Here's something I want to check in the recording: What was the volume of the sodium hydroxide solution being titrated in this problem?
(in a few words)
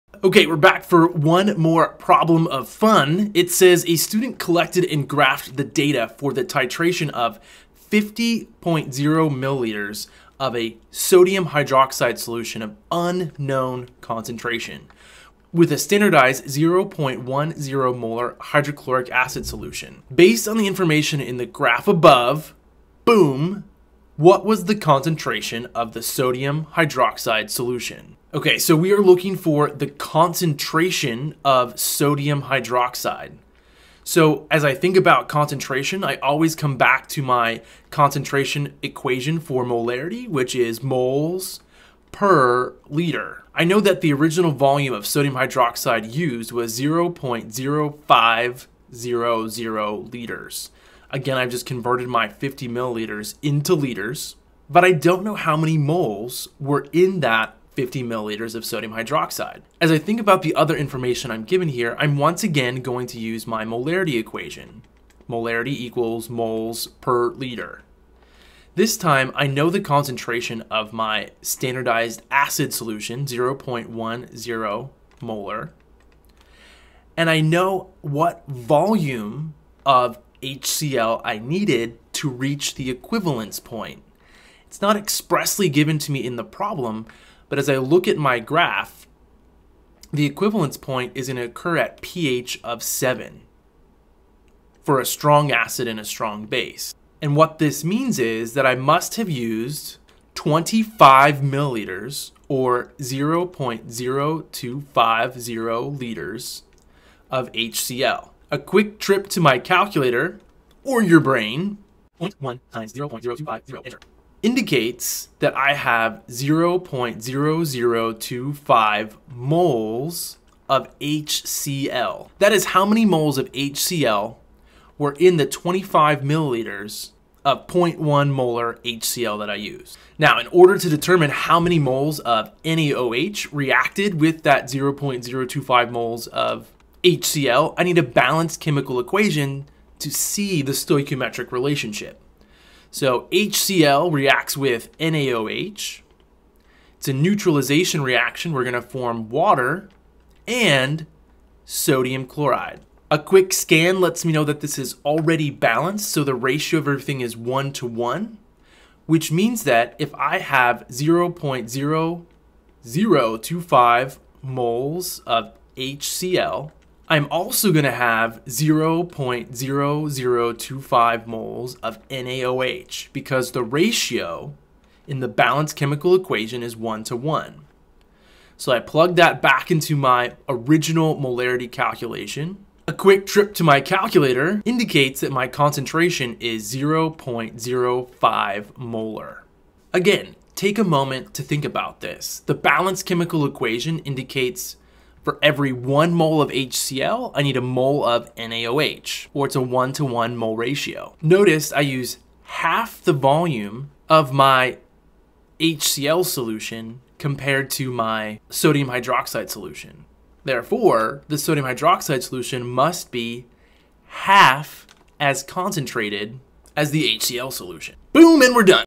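50.0 milliliters.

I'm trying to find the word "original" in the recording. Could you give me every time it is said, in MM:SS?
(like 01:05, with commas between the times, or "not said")
00:44, 03:00.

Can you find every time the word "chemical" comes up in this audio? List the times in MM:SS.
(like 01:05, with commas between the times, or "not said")
02:18, 02:55, 03:13.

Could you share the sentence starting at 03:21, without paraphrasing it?
Notice I use half the volume of my HCl solution compared to my sodium hydroxide solution.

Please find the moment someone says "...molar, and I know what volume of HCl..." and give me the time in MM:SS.
01:15.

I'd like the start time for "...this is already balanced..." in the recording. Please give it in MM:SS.
02:34.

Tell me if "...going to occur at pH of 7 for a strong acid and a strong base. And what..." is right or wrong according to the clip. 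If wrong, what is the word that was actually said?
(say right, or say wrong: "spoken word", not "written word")
right.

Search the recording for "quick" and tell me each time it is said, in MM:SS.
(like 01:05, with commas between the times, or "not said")
01:48, 02:33, 03:02.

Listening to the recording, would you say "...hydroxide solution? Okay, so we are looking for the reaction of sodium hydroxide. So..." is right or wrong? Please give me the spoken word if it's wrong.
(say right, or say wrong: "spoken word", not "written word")
wrong: "concentration", not "reaction".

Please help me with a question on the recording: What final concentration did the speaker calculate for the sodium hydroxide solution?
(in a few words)
0.05 molar.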